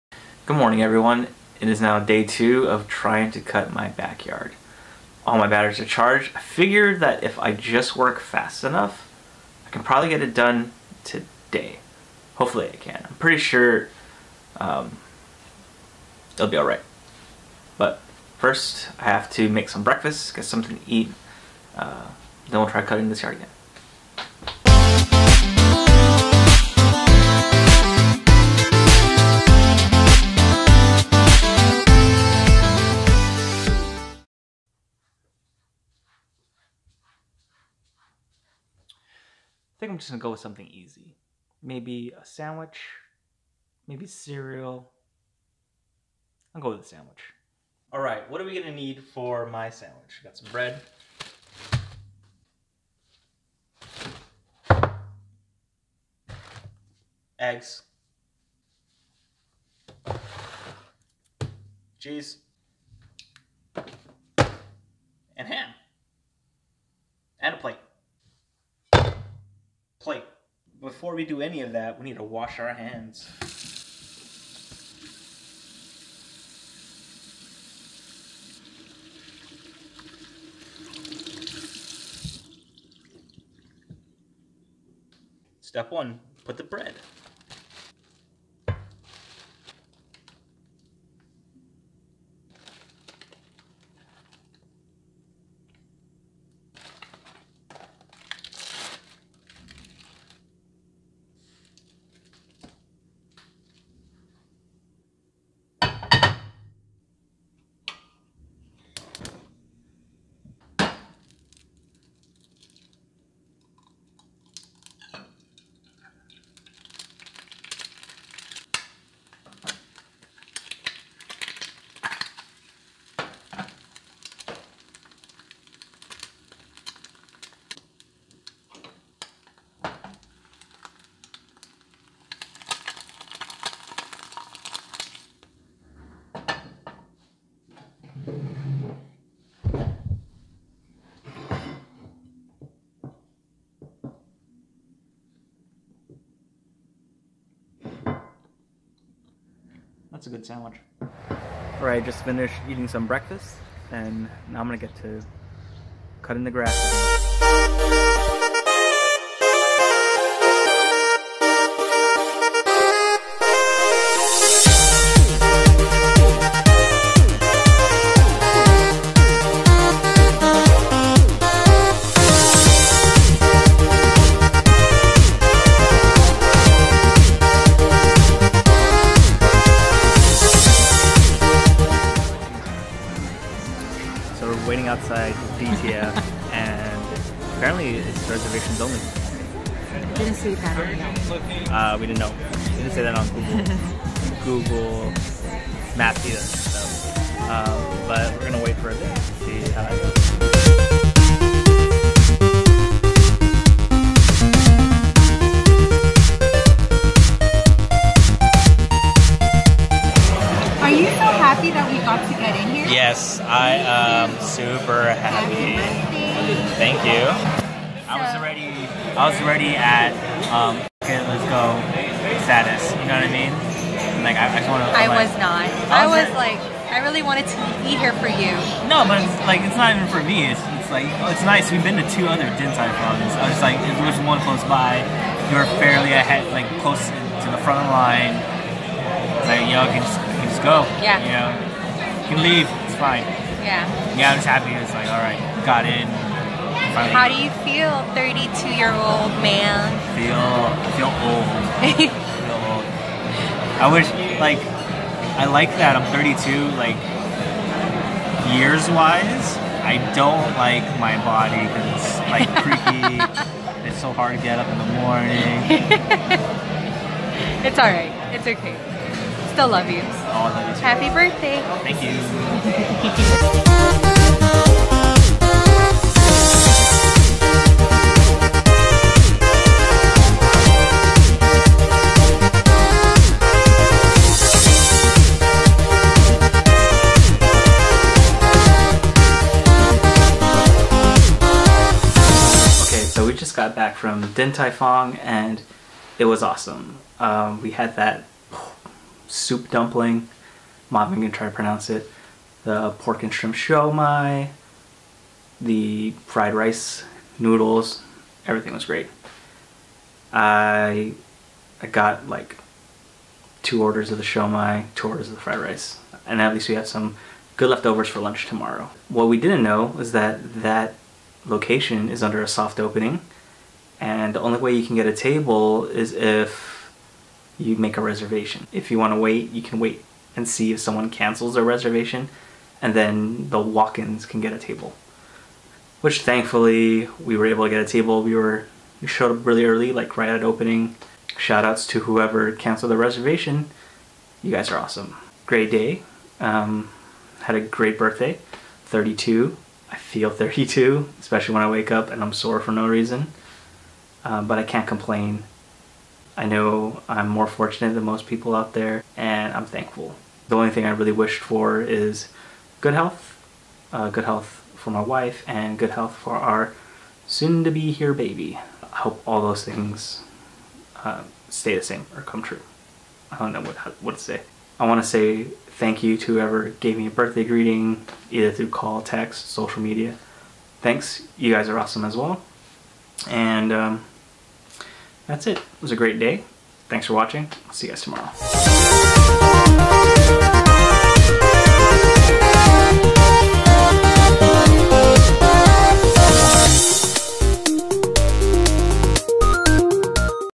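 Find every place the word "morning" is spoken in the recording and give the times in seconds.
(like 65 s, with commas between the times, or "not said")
0 s, 264 s.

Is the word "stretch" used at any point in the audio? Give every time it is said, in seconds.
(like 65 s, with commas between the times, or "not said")
not said.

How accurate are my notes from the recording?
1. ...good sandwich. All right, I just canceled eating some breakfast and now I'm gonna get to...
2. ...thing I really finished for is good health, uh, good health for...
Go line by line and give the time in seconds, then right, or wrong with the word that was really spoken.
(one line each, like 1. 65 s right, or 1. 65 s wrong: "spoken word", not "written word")
1. 150 s wrong: "finished", not "canceled"
2. 360 s wrong: "wished", not "finished".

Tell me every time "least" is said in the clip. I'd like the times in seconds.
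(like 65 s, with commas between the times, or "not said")
316 s.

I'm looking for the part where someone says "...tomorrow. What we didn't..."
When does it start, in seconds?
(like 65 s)
318 s.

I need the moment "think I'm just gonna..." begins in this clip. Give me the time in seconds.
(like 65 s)
39 s.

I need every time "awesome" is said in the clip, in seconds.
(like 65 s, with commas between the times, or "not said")
296 s, 344 s, 381 s.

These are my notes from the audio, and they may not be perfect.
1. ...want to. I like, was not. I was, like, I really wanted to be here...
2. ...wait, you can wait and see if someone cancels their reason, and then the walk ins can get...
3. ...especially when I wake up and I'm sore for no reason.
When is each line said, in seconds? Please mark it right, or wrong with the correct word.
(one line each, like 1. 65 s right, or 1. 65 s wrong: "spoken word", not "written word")
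1. 224 s right
2. 329 s wrong: "reservation", not "reason"
3. 351 s right.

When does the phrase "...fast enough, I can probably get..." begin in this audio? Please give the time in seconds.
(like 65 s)
8 s.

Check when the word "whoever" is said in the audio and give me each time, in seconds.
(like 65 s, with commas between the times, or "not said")
342 s, 376 s.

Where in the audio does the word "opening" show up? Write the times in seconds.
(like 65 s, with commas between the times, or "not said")
322 s, 340 s.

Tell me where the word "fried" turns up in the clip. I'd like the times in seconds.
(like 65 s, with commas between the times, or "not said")
306 s, 315 s.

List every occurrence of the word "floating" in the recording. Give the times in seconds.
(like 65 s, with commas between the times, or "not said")
not said.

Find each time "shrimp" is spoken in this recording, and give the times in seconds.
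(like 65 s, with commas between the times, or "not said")
303 s.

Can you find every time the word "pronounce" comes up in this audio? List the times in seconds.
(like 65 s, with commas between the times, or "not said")
301 s.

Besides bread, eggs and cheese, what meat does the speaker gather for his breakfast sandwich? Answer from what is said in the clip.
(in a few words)
Ham.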